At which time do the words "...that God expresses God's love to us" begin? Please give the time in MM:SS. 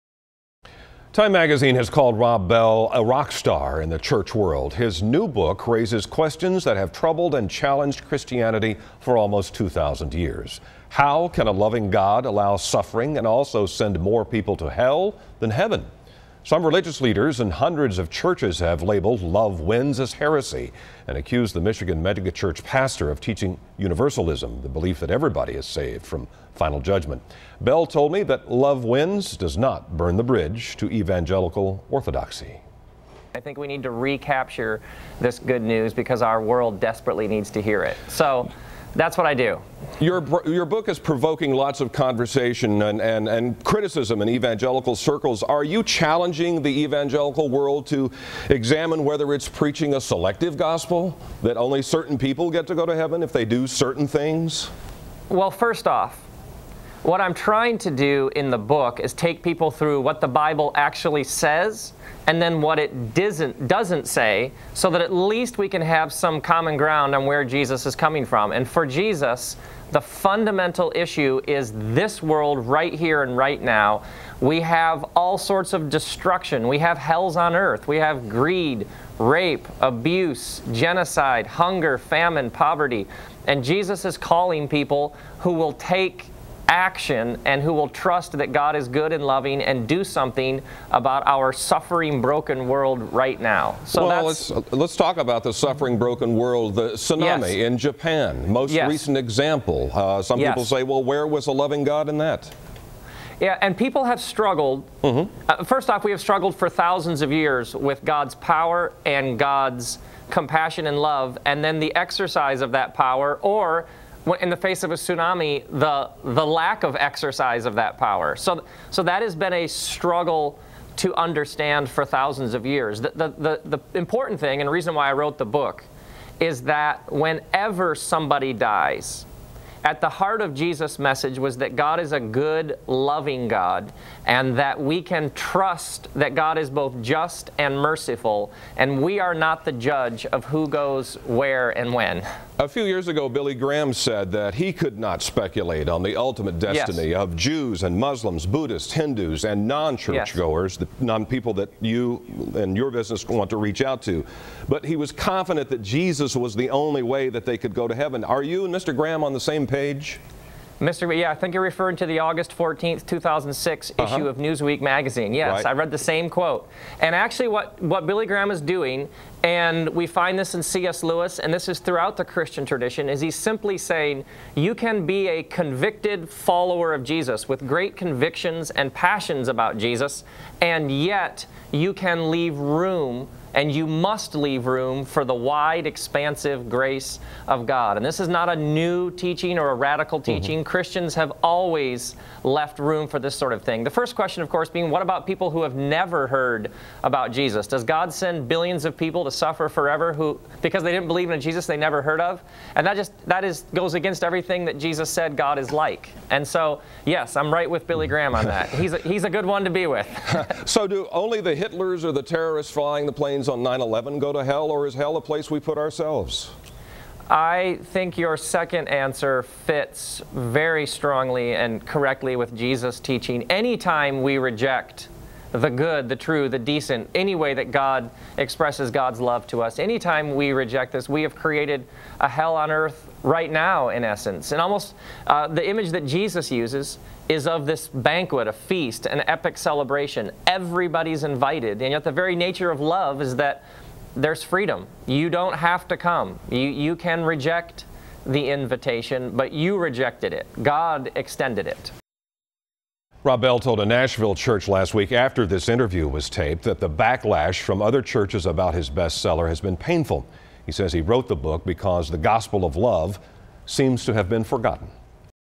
03:47.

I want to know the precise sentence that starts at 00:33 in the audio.
I think we need to recapture this good news because our world desperately needs to hear it.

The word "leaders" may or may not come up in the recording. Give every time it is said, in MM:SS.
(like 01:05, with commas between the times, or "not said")
00:17.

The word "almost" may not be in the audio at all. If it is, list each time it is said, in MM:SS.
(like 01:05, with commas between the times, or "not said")
00:09, 03:54.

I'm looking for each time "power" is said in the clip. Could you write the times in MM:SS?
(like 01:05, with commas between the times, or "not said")
01:48, 01:52, 01:57.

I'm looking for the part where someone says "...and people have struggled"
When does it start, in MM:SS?
01:43.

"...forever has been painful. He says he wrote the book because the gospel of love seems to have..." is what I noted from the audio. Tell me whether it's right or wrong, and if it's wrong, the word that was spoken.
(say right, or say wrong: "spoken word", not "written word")
wrong: "bestseller", not "forever".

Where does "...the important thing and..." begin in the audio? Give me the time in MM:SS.
02:03.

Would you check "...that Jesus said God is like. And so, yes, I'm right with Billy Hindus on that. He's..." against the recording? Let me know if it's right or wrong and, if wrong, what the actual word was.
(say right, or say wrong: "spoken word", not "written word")
wrong: "Graham", not "Hindus".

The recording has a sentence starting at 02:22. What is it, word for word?
A few years ago, Billy Graham said that he could not speculate on the ultimate destiny yes.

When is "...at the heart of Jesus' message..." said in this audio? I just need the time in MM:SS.
02:09.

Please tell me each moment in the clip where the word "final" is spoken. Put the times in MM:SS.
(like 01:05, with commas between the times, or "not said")
00:26.